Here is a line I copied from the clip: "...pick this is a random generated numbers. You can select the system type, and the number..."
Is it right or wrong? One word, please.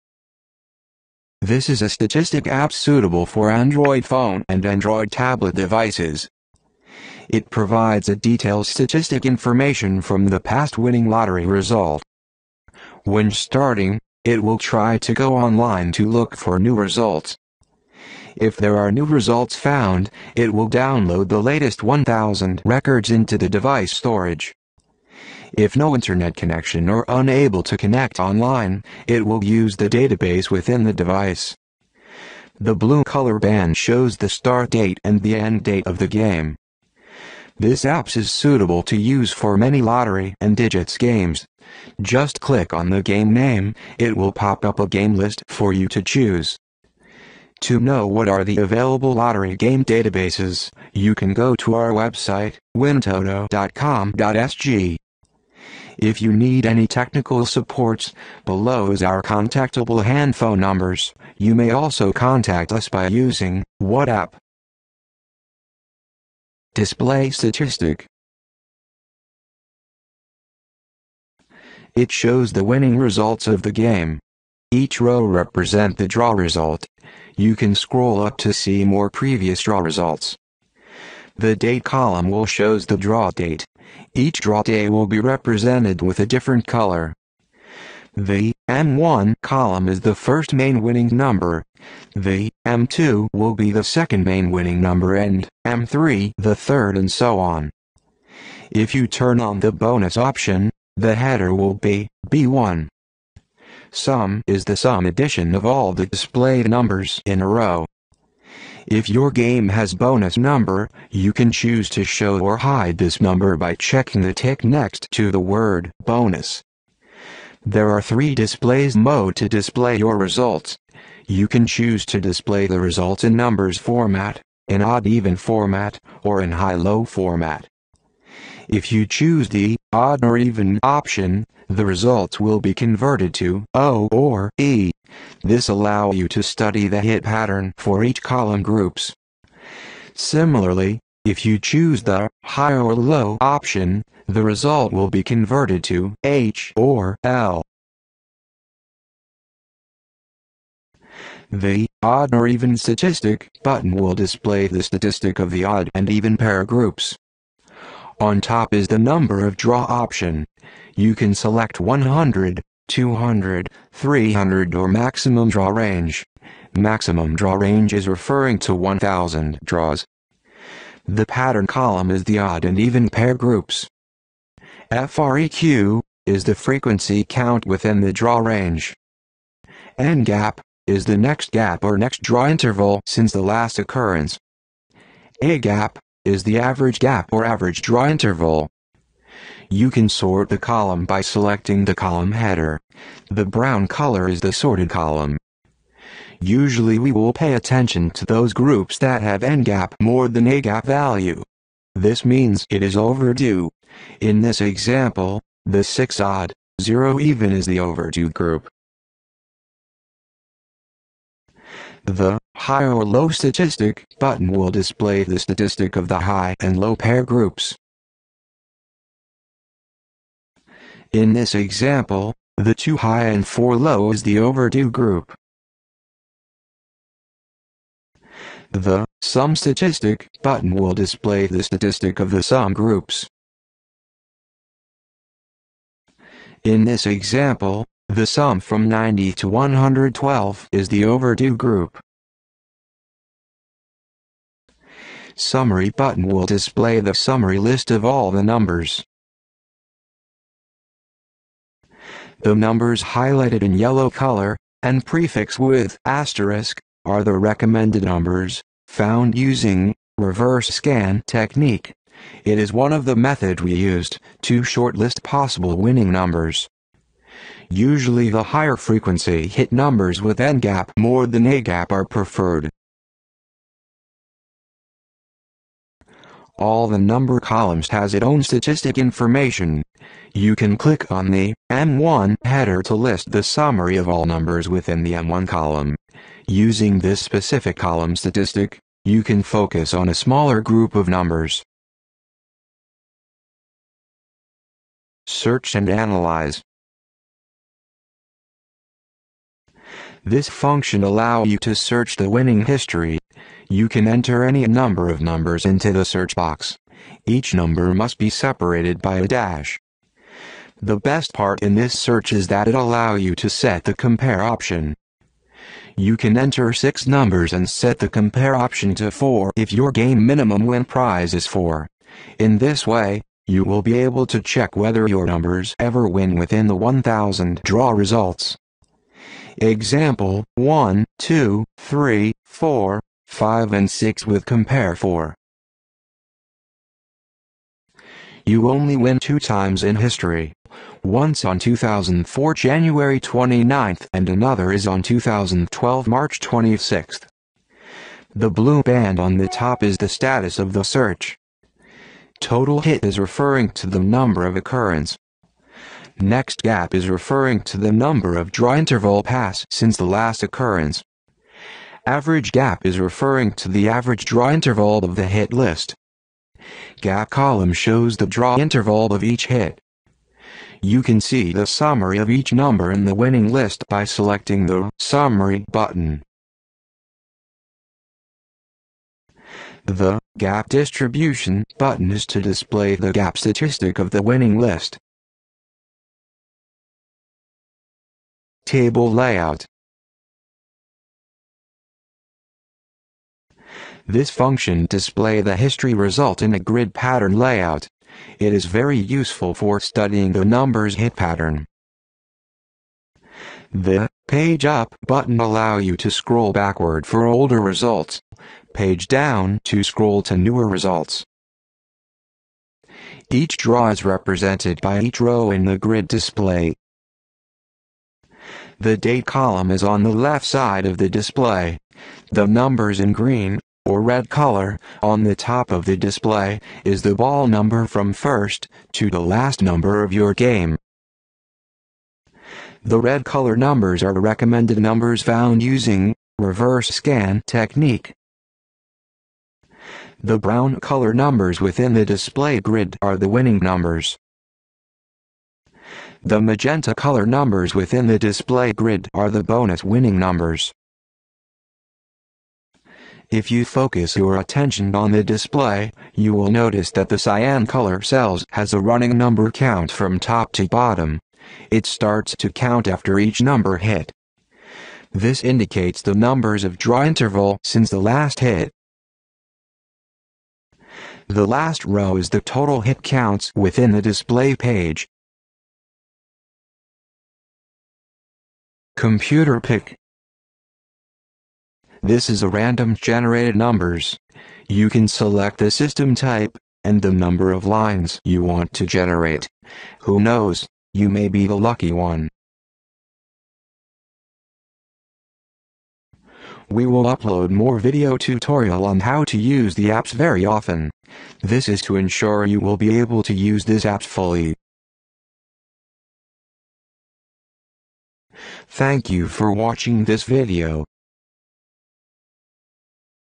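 right.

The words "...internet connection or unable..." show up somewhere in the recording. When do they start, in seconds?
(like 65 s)
25 s.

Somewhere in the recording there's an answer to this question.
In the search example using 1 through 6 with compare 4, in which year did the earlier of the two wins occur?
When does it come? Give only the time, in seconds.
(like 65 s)
341 s.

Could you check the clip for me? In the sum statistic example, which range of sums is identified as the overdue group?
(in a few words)
90 to 112.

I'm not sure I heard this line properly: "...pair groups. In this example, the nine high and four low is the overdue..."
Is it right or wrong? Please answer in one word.
wrong.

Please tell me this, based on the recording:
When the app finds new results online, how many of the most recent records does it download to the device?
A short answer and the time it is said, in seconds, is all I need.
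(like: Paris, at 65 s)
1000, at 21 s.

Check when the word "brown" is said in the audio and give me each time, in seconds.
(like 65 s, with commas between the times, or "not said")
193 s, 440 s.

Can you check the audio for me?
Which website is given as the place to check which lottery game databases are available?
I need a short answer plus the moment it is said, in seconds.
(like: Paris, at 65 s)
wintoto.com.sg, at 52 s.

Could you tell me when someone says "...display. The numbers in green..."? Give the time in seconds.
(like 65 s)
421 s.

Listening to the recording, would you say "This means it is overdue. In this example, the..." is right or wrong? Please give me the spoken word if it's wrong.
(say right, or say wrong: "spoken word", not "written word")
right.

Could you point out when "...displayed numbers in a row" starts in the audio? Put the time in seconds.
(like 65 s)
106 s.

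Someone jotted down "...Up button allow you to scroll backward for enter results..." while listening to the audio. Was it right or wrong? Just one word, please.
wrong.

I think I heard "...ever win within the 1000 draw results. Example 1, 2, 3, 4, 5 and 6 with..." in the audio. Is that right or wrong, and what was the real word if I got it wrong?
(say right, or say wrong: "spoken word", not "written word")
right.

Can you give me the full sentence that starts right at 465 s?
This indicates the numbers of draw interval since the last hit.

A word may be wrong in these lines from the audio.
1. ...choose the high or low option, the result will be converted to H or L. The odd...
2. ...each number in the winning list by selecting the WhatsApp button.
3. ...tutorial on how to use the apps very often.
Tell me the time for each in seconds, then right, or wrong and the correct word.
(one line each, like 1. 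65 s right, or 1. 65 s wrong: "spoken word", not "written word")
1. 141 s right
2. 372 s wrong: "Summary", not "WhatsApp"
3. 498 s right.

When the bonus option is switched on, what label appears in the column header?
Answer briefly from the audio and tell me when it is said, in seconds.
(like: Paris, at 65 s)
B1, at 102 s.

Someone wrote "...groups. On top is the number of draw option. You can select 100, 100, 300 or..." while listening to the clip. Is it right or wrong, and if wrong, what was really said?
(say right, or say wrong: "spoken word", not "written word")
wrong: "200", not "100".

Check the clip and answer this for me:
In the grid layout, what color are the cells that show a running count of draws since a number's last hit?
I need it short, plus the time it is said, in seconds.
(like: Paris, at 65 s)
Cyan, at 457 s.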